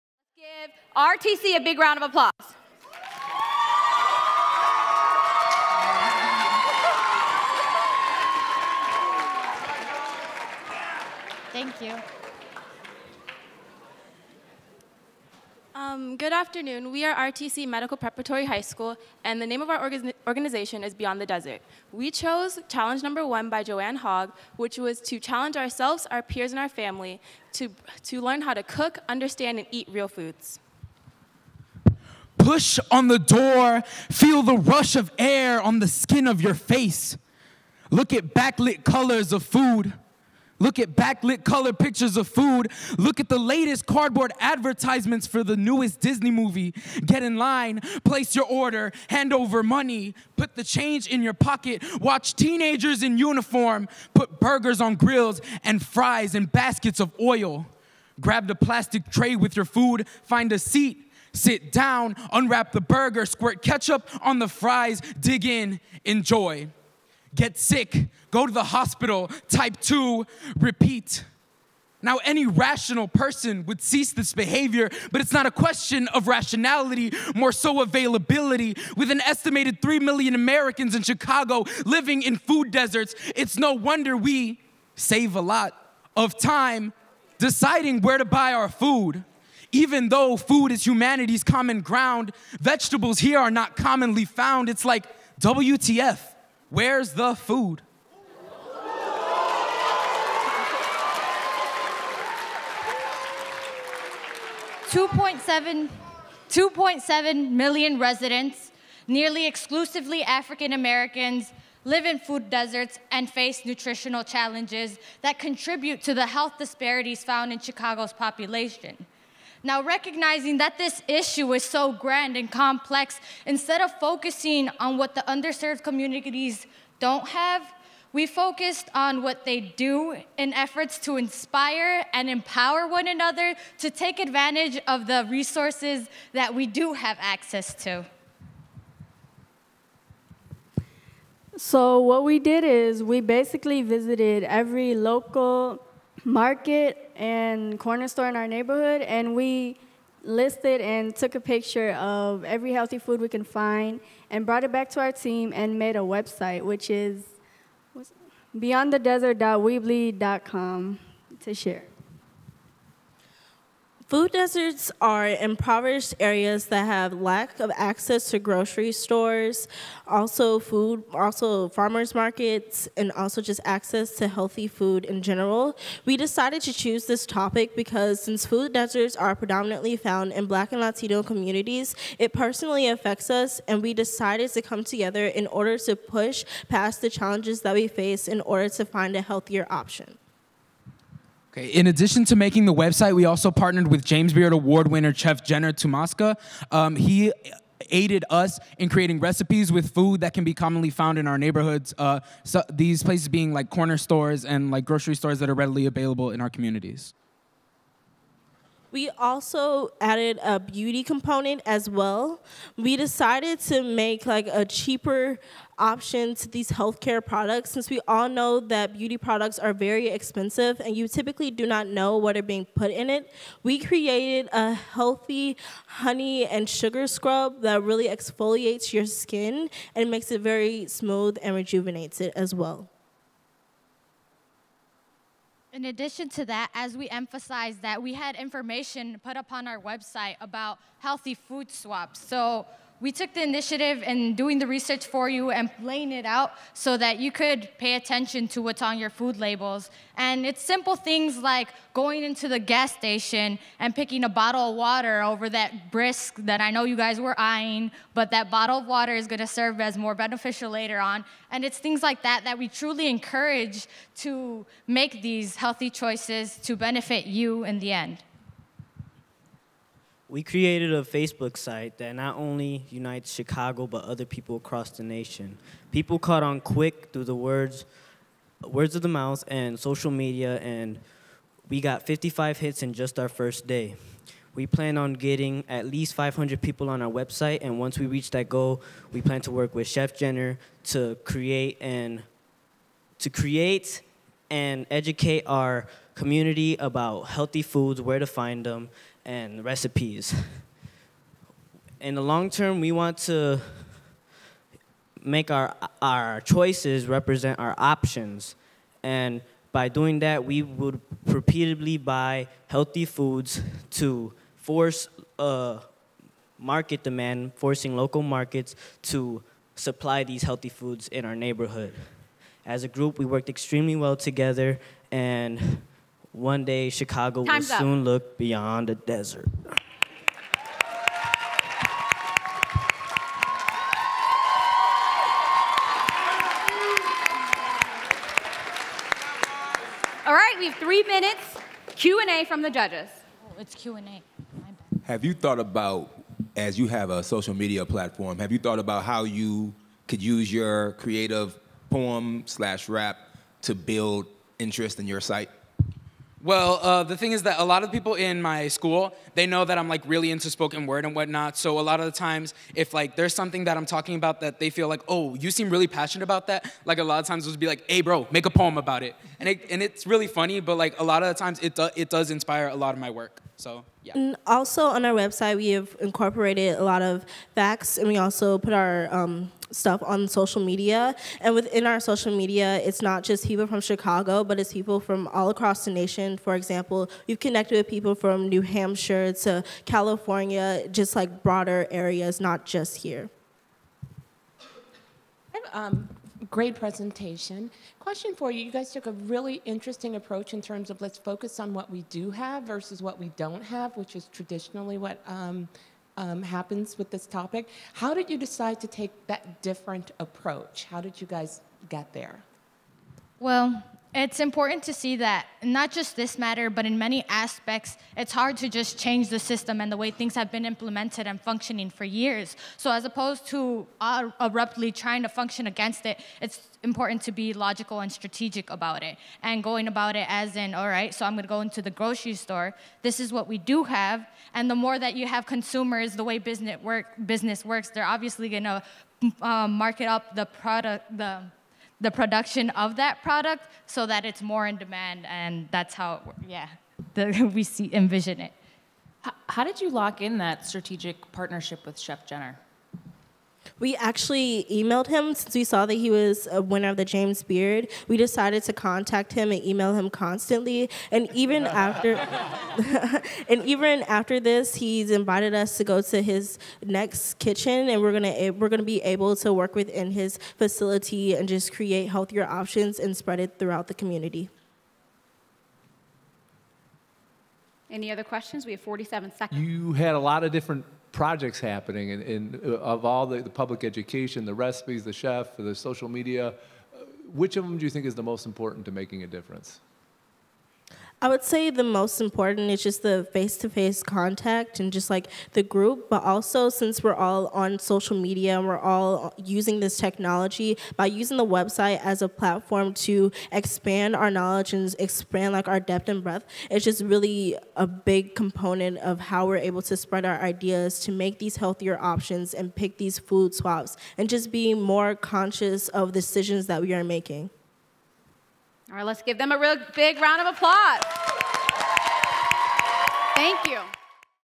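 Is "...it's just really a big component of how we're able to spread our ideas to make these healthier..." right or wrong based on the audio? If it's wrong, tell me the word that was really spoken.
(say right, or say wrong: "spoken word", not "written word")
right.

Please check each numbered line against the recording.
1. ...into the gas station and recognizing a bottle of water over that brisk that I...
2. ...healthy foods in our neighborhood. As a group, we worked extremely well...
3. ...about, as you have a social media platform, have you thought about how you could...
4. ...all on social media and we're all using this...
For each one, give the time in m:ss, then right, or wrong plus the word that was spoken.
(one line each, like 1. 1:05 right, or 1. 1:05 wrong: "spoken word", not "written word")
1. 4:12 wrong: "picking", not "recognizing"
2. 5:20 right
3. 5:45 right
4. 8:17 right.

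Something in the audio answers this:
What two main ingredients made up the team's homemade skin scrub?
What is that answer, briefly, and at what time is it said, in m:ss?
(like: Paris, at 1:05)
honey and sugar, at 3:45.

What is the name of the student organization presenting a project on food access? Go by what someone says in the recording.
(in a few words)
Beyond the Desert.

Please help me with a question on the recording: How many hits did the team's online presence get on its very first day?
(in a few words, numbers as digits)
55.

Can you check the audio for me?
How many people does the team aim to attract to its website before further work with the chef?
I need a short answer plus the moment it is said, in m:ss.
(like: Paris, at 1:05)
500, at 4:46.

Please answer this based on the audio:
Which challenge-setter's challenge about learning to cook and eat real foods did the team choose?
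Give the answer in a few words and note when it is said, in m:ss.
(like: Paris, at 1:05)
Joanne Hogg, at 0:23.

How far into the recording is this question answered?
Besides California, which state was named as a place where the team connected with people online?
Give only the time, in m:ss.
6:28.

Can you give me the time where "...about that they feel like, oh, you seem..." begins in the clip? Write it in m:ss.
6:04.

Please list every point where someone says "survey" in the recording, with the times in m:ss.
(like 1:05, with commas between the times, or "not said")
not said.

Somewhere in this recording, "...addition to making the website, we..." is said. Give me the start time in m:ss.
3:11.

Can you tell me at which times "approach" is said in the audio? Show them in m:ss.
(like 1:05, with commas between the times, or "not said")
6:40, 6:50.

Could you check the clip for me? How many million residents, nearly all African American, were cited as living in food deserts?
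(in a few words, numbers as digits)
2.7 million.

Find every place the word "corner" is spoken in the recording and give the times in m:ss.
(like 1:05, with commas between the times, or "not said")
2:27, 3:23.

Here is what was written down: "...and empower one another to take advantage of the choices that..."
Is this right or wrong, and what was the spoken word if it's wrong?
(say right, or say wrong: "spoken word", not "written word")
wrong: "resources", not "choices".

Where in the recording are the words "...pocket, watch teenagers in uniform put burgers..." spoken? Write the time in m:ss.
0:51.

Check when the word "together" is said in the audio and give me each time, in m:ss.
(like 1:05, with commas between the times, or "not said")
3:04, 5:24.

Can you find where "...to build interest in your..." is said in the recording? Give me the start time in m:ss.
5:53.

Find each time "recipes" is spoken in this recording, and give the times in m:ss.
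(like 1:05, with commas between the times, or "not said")
3:19, 4:59, 8:04.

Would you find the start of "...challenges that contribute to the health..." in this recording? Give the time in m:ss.
1:54.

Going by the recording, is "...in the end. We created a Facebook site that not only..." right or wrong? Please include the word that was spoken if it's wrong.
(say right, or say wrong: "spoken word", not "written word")
right.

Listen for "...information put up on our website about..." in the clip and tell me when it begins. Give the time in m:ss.
3:58.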